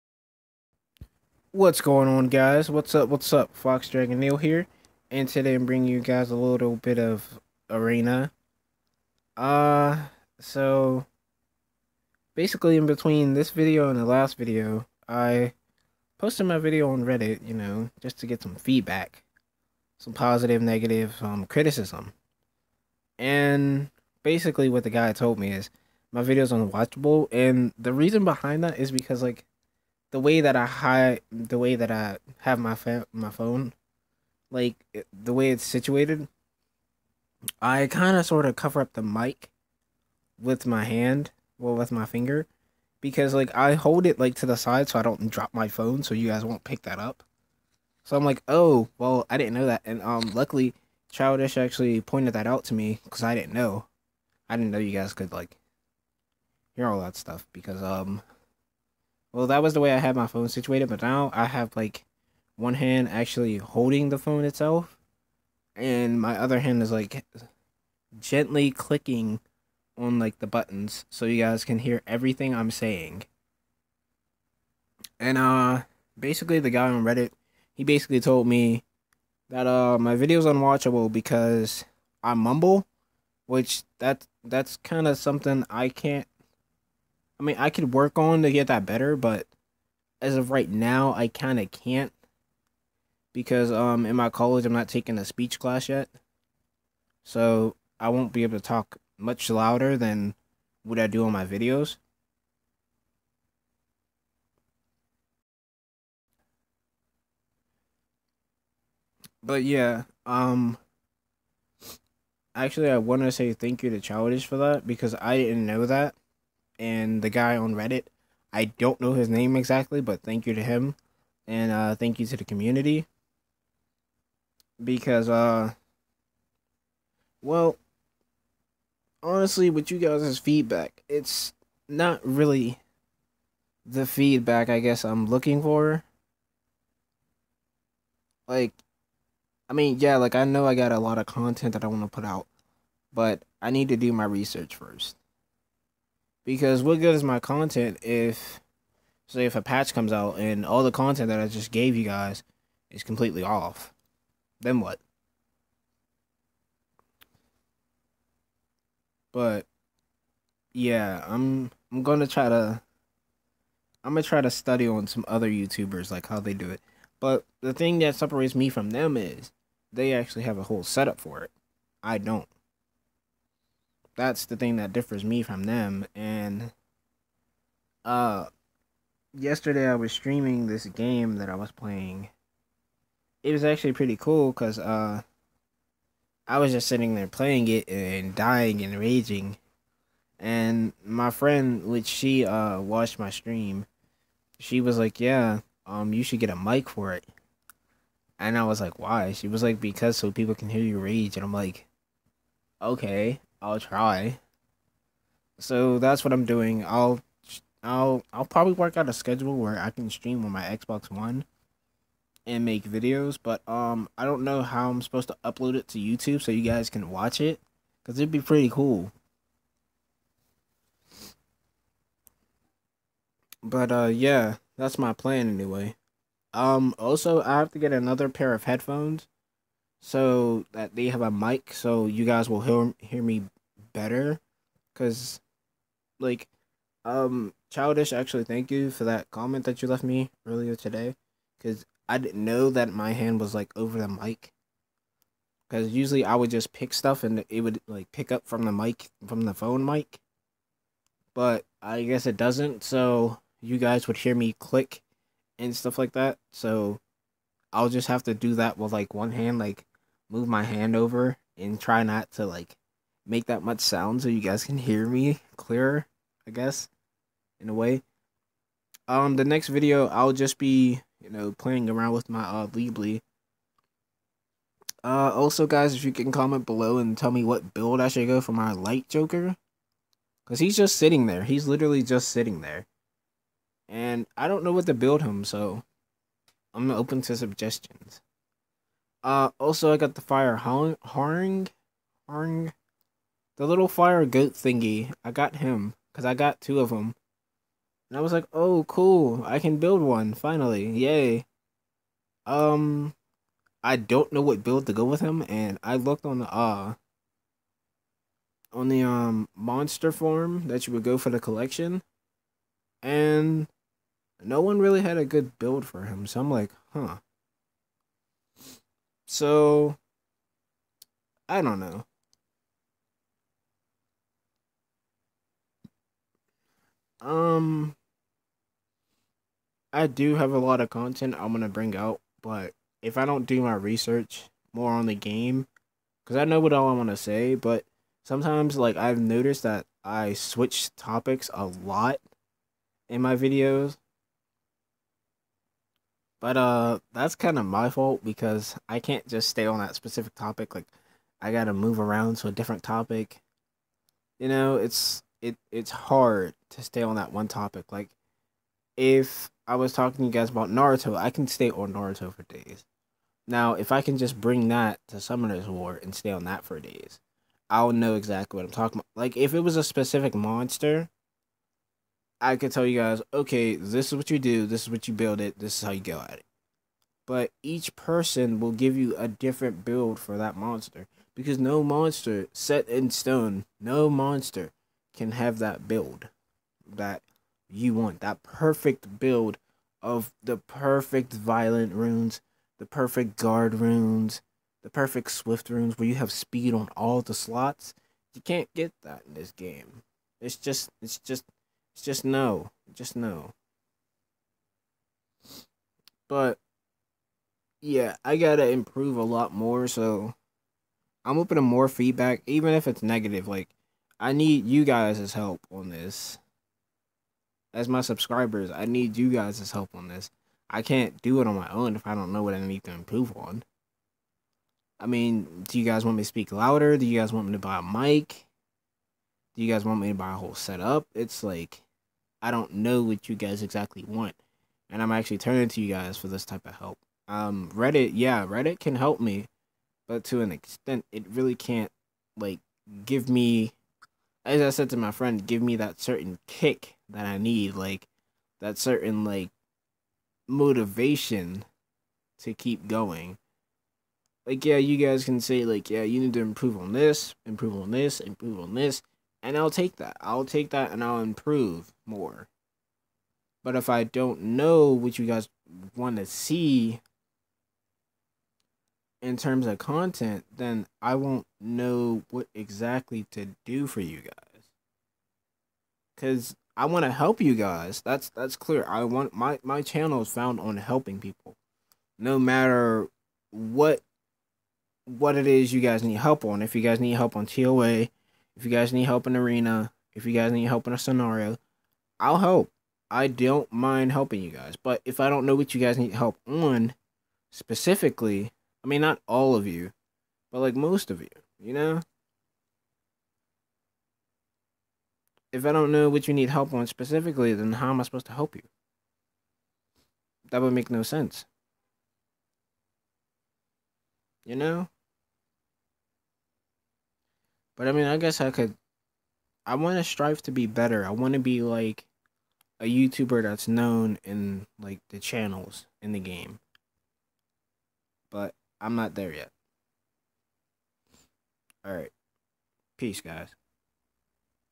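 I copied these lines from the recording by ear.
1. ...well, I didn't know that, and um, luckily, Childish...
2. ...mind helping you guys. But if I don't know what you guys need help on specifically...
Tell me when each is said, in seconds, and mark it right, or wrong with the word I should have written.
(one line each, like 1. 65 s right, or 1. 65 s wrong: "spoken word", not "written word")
1. 48 s right
2. 493 s right.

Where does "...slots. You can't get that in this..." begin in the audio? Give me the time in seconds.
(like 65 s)
397 s.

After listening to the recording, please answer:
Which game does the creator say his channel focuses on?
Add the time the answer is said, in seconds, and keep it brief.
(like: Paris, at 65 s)
Summoner's War, at 365 s.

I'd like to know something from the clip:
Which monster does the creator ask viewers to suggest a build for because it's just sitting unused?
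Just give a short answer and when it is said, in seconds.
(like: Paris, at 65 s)
Light Joker, at 278 s.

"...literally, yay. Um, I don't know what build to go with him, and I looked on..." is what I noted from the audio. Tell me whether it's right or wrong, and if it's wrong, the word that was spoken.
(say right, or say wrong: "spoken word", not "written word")
wrong: "finally", not "literally".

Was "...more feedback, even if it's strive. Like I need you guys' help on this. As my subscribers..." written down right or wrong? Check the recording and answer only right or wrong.
wrong.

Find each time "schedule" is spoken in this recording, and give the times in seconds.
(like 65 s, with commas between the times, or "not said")
209 s.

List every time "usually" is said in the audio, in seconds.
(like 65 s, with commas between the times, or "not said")
245 s.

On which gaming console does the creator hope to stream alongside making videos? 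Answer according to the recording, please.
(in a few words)
Xbox One.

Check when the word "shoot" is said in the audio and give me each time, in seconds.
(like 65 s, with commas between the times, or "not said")
not said.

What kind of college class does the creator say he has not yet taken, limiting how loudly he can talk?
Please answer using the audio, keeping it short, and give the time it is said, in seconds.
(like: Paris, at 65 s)
speech class, at 95 s.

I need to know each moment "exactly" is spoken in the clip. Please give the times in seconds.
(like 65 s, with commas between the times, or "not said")
119 s, 368 s, 433 s, 472 s.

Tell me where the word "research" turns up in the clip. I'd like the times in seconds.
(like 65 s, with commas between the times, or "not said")
144 s, 333 s.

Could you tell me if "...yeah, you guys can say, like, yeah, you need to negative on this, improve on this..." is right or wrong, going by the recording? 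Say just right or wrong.
wrong.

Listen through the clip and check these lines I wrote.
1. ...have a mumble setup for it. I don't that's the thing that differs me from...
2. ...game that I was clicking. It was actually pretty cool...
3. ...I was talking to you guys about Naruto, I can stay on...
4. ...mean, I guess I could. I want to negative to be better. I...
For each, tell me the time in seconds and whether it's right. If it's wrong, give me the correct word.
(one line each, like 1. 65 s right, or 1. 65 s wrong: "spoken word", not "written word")
1. 170 s wrong: "whole", not "mumble"
2. 180 s wrong: "playing", not "clicking"
3. 359 s right
4. 517 s wrong: "strive", not "negative".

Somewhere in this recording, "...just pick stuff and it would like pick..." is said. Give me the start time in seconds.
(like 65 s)
246 s.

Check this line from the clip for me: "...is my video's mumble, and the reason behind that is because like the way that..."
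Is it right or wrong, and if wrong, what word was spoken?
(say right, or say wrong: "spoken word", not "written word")
wrong: "unwatchable", not "mumble".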